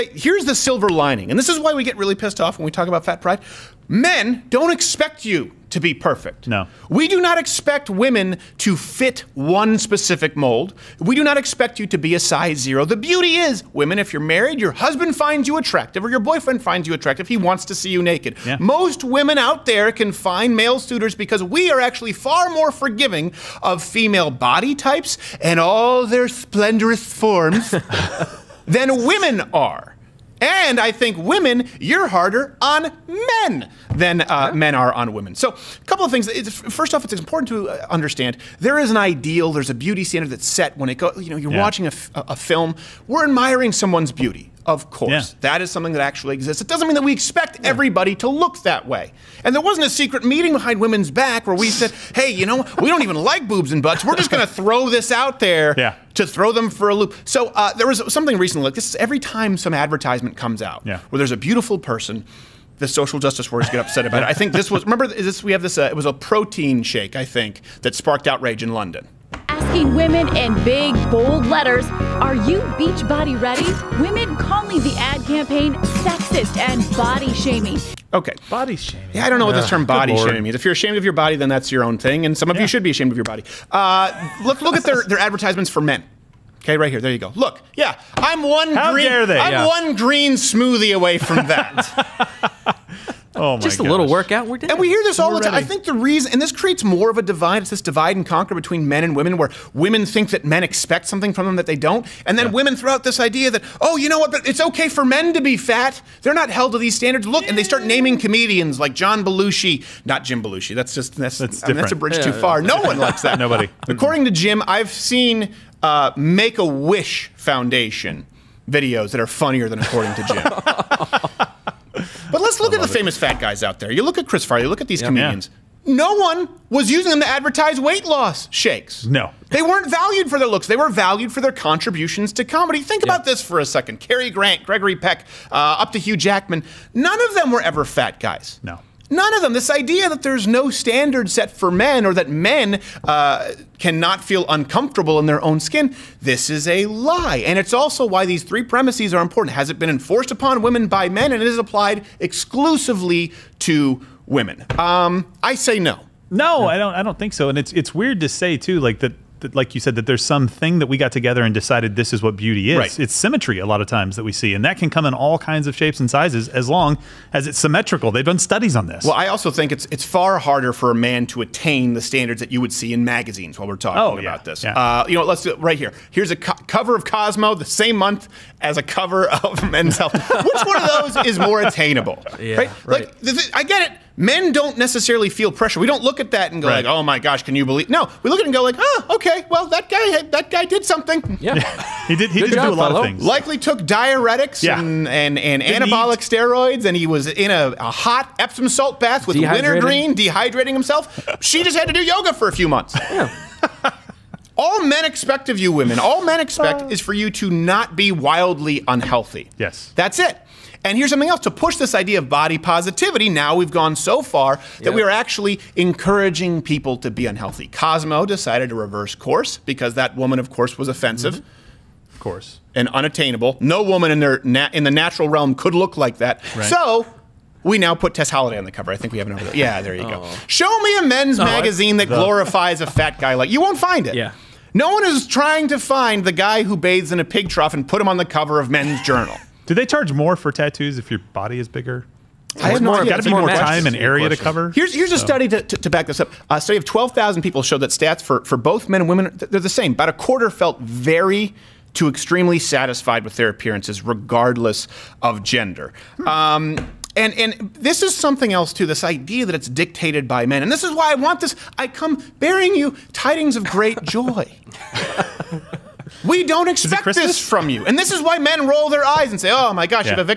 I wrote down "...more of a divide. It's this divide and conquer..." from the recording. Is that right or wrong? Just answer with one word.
right.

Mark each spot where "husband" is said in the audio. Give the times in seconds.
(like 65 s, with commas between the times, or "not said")
14 s.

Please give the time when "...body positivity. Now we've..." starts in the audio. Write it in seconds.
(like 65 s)
212 s.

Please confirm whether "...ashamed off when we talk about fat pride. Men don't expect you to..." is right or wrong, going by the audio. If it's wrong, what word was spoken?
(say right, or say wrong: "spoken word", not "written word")
wrong: "pissed", not "ashamed".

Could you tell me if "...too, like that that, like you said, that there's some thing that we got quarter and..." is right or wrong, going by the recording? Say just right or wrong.
wrong.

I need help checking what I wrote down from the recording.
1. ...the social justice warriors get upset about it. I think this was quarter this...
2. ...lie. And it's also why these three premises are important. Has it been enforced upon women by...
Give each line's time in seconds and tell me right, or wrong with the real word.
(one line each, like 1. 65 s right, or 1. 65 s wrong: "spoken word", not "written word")
1. 62 s wrong: "remember", not "quarter"
2. 146 s right.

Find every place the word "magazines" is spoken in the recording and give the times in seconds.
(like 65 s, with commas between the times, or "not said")
173 s, 231 s.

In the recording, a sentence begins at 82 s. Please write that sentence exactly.
you should be ashamed of your body.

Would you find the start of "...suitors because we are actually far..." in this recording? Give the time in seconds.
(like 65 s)
20 s.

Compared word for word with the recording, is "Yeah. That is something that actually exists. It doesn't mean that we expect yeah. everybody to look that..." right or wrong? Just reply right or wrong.
right.